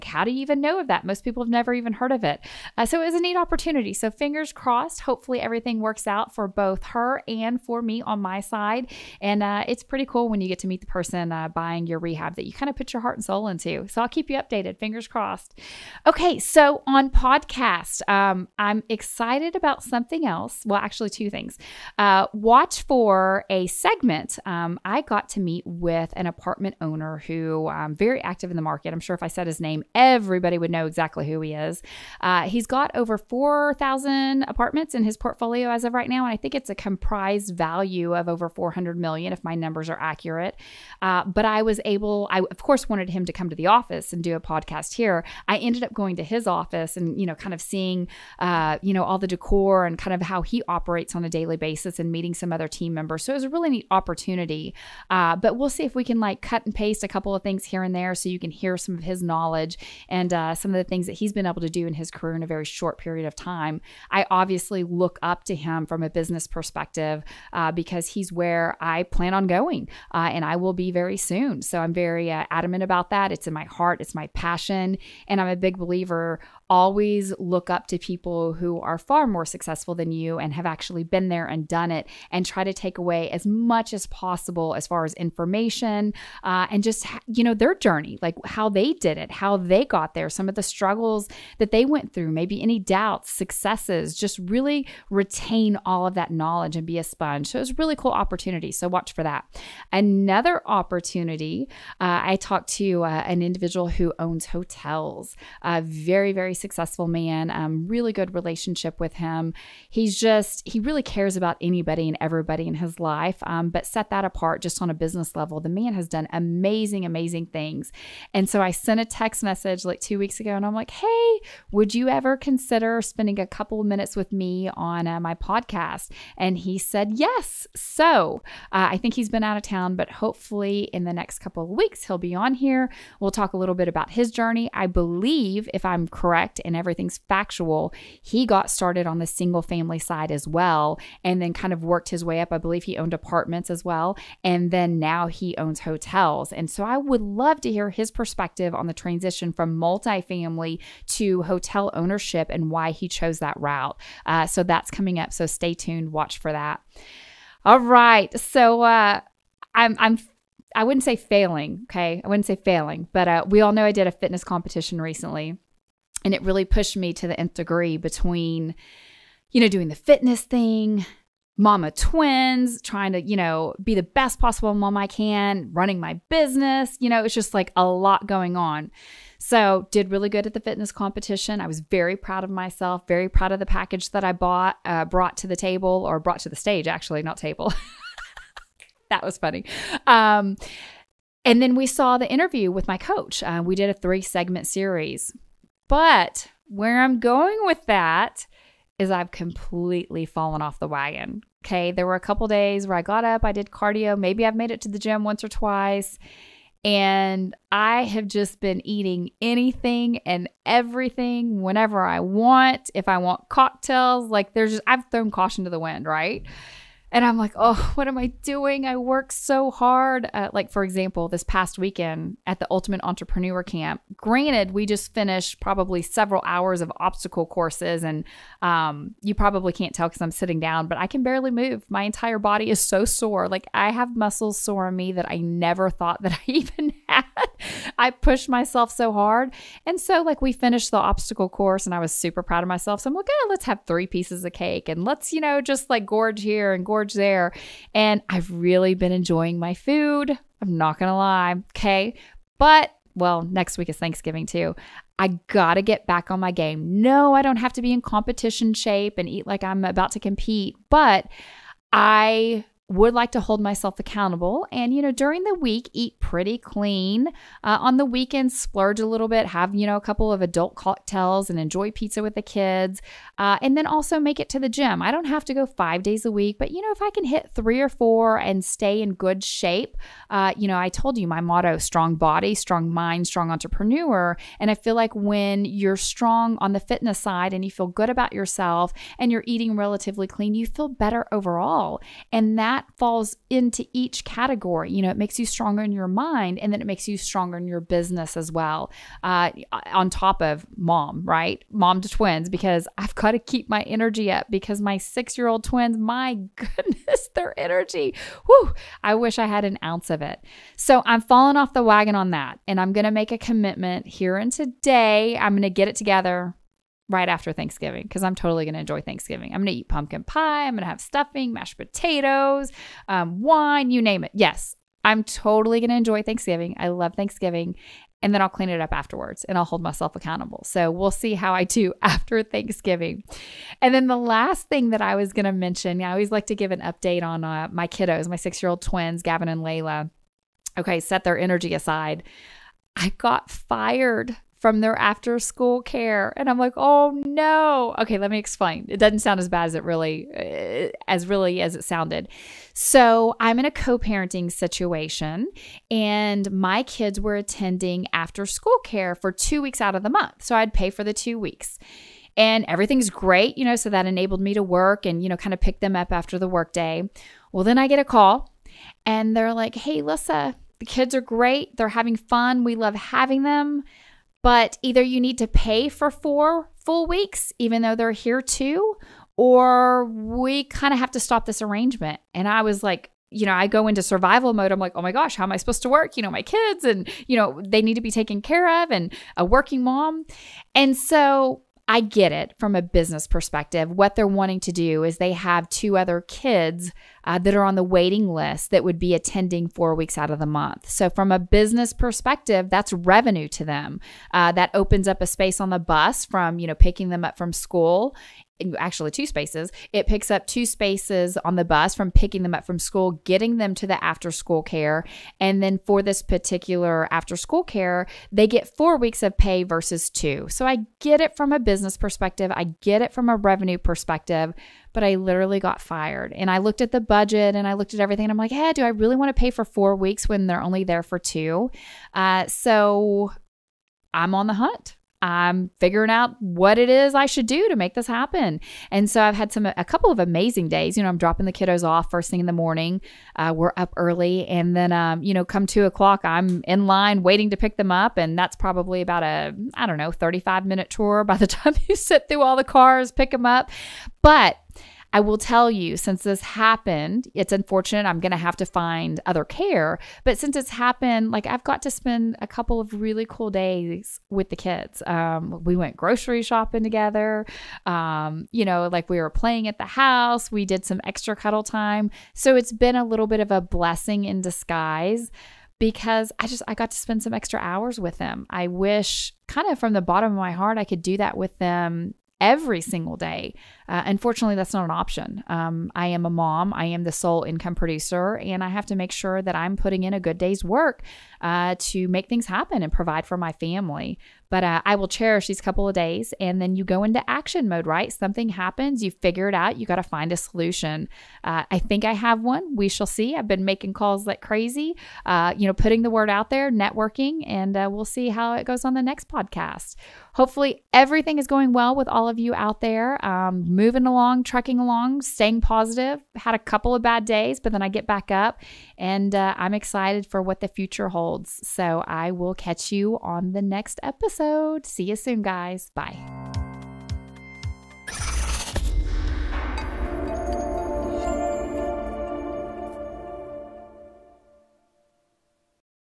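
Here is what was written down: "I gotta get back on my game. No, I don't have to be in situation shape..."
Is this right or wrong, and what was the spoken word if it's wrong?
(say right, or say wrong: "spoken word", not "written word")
wrong: "competition", not "situation".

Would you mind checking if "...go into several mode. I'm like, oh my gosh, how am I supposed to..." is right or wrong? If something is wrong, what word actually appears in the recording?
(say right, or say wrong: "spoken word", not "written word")
wrong: "survival", not "several".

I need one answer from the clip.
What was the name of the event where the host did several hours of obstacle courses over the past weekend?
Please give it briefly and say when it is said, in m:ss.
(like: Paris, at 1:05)
Ultimate Entrepreneur Camp, at 3:42.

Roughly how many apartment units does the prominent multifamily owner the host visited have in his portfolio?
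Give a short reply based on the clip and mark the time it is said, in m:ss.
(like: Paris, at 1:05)
4,000, at 0:33.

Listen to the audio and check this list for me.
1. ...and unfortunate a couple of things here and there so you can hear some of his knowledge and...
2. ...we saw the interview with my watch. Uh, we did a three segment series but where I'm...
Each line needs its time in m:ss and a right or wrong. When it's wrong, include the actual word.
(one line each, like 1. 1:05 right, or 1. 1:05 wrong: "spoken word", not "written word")
1. 0:56 wrong: "paste", not "unfortunate"
2. 3:11 wrong: "coach", not "watch".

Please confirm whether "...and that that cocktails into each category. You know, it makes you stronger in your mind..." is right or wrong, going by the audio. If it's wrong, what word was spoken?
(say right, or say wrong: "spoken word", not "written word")
wrong: "falls", not "cocktails".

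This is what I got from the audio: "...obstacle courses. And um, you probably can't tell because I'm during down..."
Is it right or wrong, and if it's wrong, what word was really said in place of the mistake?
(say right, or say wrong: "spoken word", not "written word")
wrong: "sitting", not "during".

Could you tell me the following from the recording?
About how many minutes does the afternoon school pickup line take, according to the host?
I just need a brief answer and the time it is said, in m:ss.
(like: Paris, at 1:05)
35, at 7:30.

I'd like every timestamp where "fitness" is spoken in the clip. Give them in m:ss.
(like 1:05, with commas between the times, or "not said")
2:44, 2:49, 3:00, 4:46.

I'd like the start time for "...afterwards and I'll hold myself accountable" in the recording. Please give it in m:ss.
5:28.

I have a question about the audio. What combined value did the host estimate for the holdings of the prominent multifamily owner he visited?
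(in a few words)
400 million.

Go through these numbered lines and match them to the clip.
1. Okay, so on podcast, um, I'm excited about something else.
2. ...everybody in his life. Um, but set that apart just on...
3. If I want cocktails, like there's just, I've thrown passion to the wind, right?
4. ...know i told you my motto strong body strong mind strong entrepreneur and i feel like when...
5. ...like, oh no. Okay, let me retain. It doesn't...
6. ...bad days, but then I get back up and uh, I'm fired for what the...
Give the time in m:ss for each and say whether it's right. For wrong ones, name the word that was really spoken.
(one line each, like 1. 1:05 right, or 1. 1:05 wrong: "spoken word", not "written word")
1. 0:16 right
2. 1:52 right
3. 3:32 wrong: "caution", not "passion"
4. 4:40 right
5. 5:46 wrong: "explain", not "retain"
6. 8:37 wrong: "excited", not "fired".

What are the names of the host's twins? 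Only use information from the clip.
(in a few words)
Gavin and Layla.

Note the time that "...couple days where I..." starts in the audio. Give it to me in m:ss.
3:22.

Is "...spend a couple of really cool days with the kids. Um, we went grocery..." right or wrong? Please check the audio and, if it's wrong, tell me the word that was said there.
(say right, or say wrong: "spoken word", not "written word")
right.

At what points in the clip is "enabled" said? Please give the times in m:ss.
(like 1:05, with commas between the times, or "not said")
6:04.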